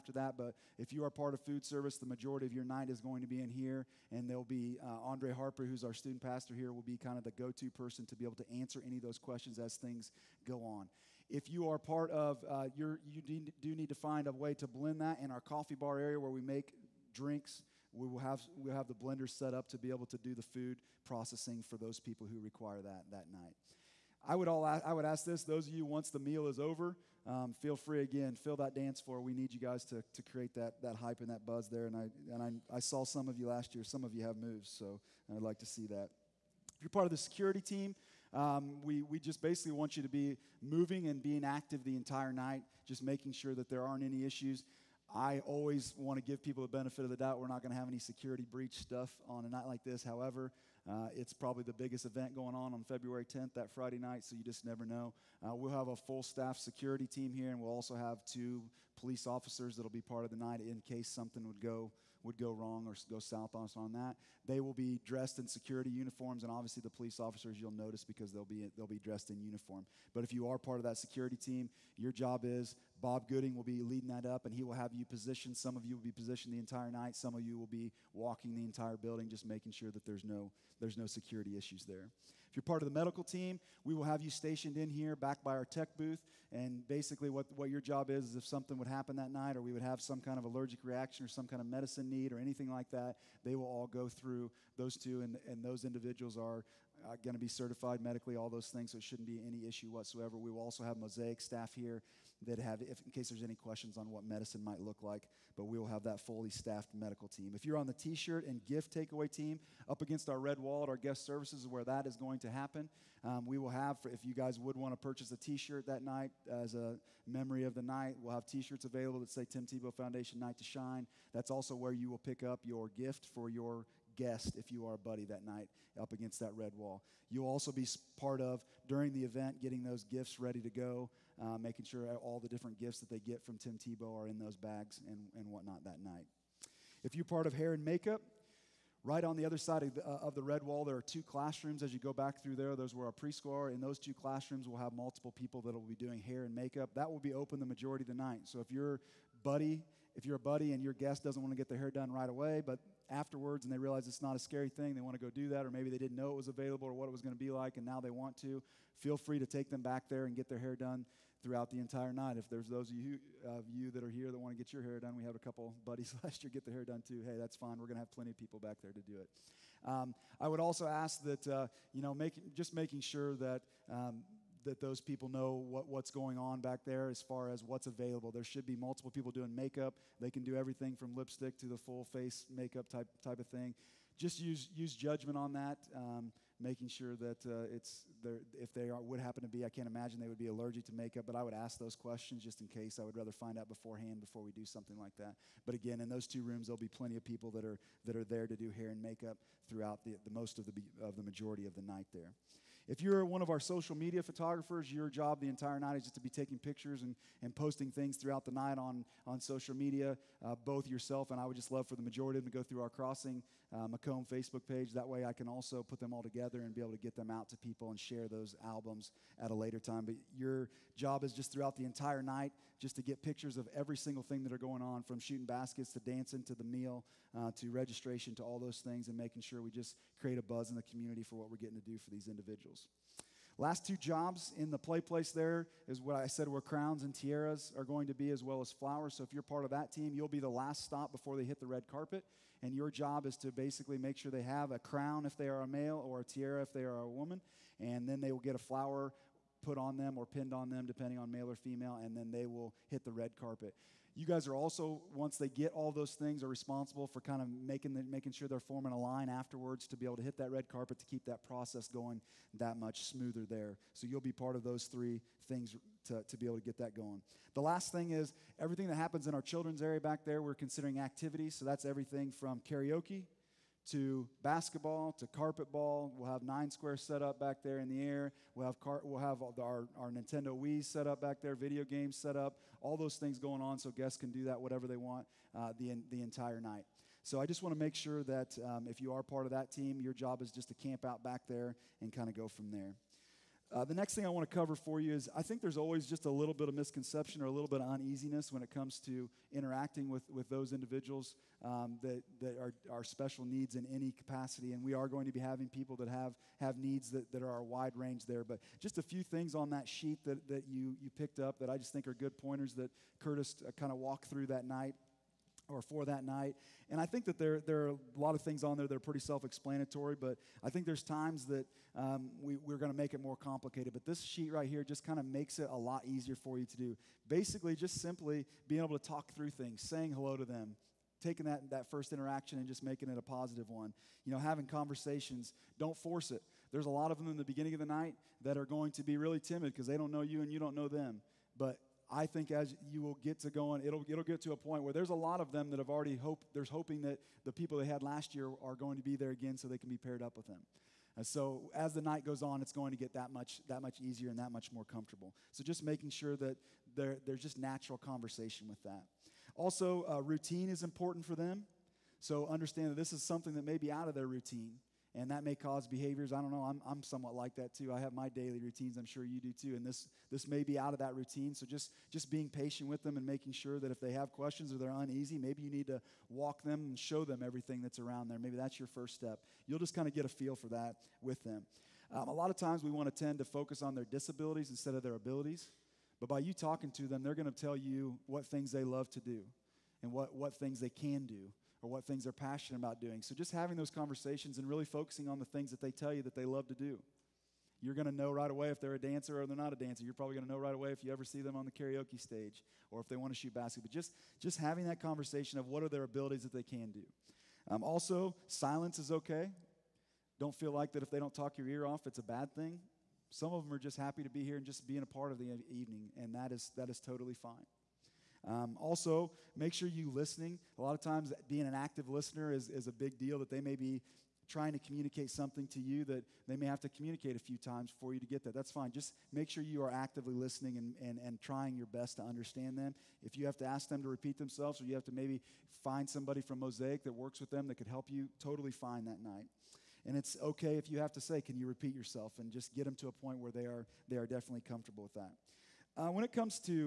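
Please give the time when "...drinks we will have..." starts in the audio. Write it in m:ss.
0:17.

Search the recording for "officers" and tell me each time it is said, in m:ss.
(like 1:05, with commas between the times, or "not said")
0:59, 1:07.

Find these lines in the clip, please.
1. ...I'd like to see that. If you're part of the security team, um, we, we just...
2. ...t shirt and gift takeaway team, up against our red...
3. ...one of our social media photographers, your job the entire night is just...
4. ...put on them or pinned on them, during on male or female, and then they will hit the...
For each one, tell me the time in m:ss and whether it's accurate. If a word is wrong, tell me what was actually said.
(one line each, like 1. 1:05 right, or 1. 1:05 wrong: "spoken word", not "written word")
1. 0:35 right
2. 1:47 right
3. 3:23 right
4. 4:09 wrong: "depending", not "during".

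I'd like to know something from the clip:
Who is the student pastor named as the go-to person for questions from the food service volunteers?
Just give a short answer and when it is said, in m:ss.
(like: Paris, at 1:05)
Andre Harper, at 0:05.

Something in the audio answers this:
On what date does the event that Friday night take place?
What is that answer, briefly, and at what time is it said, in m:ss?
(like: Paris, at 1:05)
February 10th, at 0:52.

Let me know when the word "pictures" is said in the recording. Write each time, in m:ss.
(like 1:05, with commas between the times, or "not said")
3:26, 3:43.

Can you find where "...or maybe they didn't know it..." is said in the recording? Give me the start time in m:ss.
2:35.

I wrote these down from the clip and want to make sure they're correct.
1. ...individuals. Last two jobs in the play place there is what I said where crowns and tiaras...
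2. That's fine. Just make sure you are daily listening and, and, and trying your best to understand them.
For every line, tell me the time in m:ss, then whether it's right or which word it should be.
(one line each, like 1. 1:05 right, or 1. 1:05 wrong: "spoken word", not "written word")
1. 3:52 right
2. 7:08 wrong: "actively", not "daily".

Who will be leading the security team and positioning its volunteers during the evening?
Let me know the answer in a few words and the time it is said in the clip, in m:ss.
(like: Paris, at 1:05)
Bob Gooding, at 1:13.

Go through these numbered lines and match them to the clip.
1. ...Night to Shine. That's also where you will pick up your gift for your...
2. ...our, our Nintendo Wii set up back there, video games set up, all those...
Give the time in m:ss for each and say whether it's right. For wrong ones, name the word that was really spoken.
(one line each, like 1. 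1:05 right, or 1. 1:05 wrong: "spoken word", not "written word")
1. 2:00 right
2. 4:39 right.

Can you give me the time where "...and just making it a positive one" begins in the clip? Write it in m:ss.
5:32.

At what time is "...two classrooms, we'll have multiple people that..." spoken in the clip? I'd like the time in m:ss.
2:23.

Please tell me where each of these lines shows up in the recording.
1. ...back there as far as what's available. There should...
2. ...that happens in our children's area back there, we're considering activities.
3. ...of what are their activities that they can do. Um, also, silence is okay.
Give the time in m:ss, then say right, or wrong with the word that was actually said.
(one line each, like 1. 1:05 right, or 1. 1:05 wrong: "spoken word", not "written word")
1. 2:56 right
2. 4:28 right
3. 6:45 wrong: "abilities", not "activities".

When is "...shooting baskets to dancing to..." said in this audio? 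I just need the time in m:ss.
3:45.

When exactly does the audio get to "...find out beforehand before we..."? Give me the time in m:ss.
3:13.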